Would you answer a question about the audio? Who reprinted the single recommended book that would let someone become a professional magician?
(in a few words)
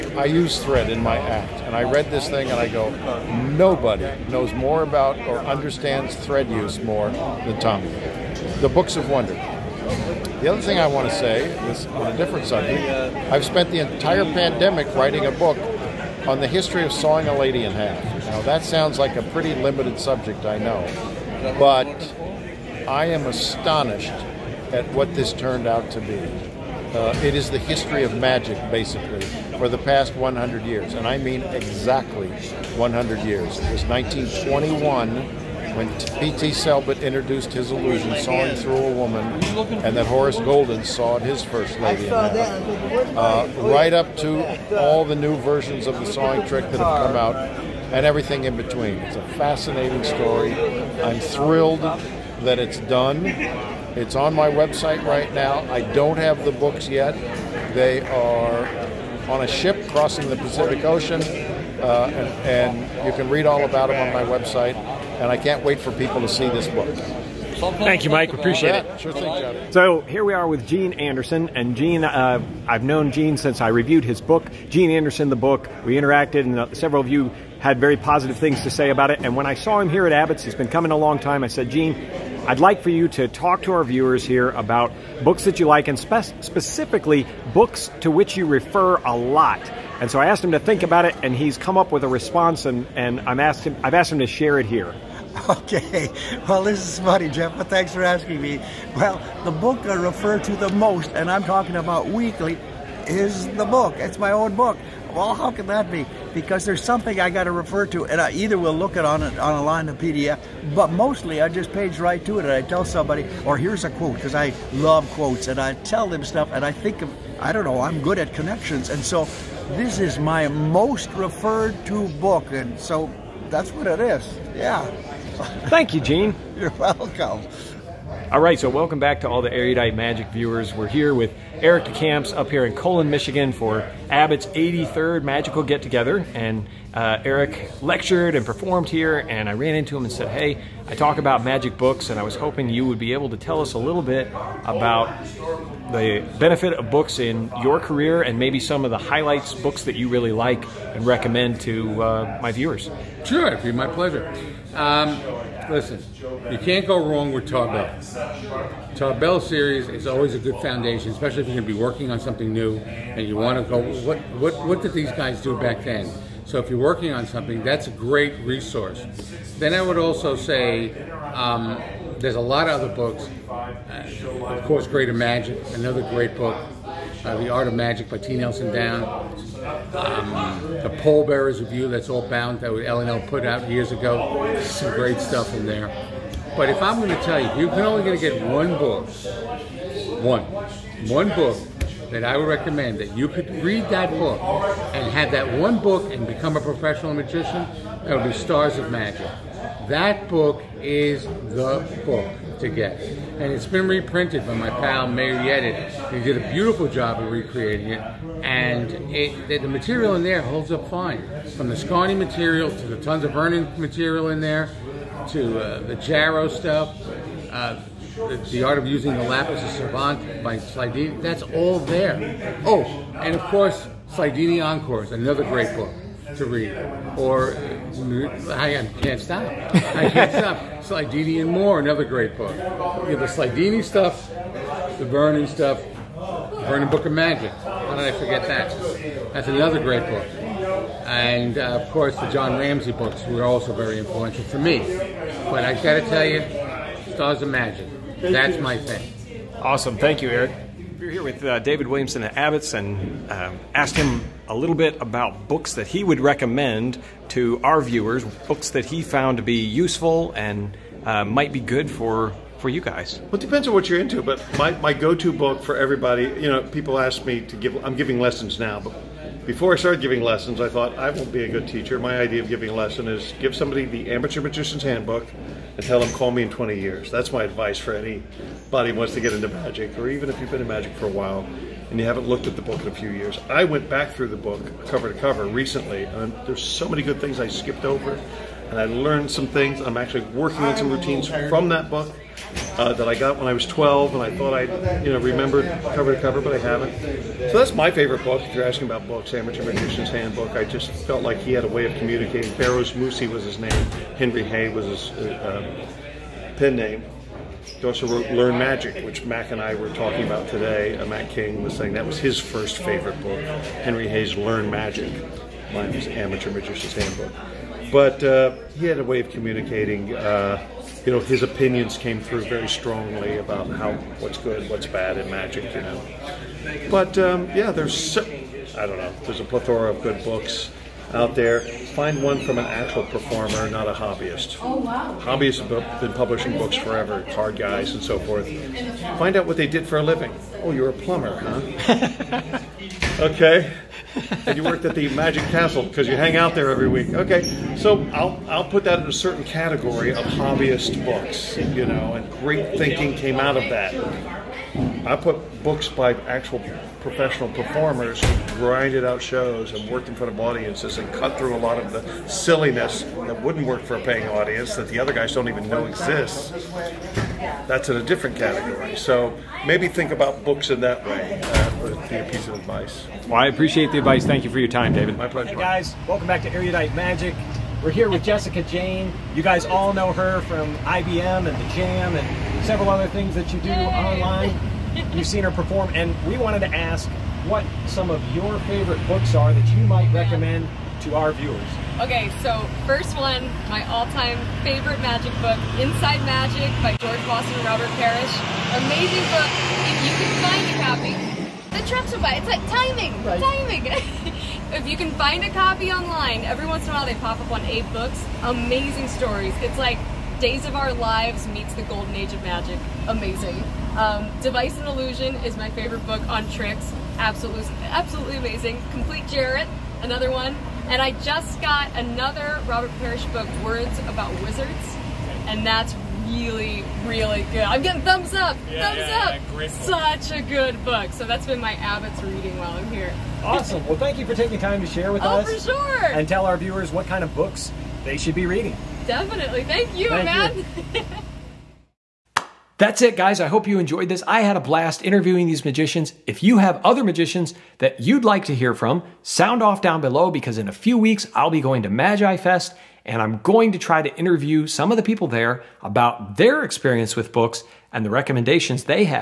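Meir Yedid.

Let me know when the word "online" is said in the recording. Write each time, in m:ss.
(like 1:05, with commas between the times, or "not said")
6:23, 6:45.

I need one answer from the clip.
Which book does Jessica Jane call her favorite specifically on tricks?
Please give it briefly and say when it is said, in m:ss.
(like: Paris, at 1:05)
Device and Illusion, at 6:54.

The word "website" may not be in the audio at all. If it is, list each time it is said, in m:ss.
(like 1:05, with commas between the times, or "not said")
0:54, 1:04.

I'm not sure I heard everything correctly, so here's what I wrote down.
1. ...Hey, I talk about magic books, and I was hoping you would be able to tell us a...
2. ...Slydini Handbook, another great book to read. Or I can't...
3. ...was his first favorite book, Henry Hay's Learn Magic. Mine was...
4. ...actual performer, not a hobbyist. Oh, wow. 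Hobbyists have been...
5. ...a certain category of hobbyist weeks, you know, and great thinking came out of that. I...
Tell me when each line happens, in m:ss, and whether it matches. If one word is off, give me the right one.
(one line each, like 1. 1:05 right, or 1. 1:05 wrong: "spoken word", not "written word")
1. 2:20 right
2. 3:44 wrong: "Encores", not "Handbook"
3. 5:12 right
4. 5:32 right
5. 5:49 wrong: "books", not "weeks".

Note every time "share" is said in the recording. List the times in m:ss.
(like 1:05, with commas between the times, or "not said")
1:34, 7:14.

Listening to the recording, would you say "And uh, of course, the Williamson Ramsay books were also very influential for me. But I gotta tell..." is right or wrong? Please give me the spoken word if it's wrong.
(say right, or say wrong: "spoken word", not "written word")
wrong: "John", not "Williamson".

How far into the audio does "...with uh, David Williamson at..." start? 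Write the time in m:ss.
4:11.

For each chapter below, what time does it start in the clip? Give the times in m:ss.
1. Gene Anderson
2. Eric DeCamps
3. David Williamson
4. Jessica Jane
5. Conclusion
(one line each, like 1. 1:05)
1. 1:09
2. 2:08
3. 4:11
4. 6:15
5. 7:21.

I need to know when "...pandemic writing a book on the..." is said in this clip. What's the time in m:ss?
0:14.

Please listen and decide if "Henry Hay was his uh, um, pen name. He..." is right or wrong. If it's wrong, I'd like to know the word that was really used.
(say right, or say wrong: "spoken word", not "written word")
right.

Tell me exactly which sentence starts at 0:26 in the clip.
Uh, it is the history of magic, basically, for the past 100 years, and I mean exactly 100 years.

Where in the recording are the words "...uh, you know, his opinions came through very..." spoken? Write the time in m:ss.
5:20.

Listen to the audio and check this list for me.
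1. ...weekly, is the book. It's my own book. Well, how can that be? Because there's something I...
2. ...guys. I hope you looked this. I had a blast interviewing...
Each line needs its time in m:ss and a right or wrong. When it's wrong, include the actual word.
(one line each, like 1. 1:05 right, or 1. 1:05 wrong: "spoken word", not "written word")
1. 1:42 right
2. 7:23 wrong: "enjoyed", not "looked".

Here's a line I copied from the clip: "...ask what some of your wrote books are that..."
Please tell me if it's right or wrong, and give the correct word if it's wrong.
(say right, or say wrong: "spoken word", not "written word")
wrong: "favorite", not "wrote".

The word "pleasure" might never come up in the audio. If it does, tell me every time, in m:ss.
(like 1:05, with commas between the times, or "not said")
2:33, 6:15.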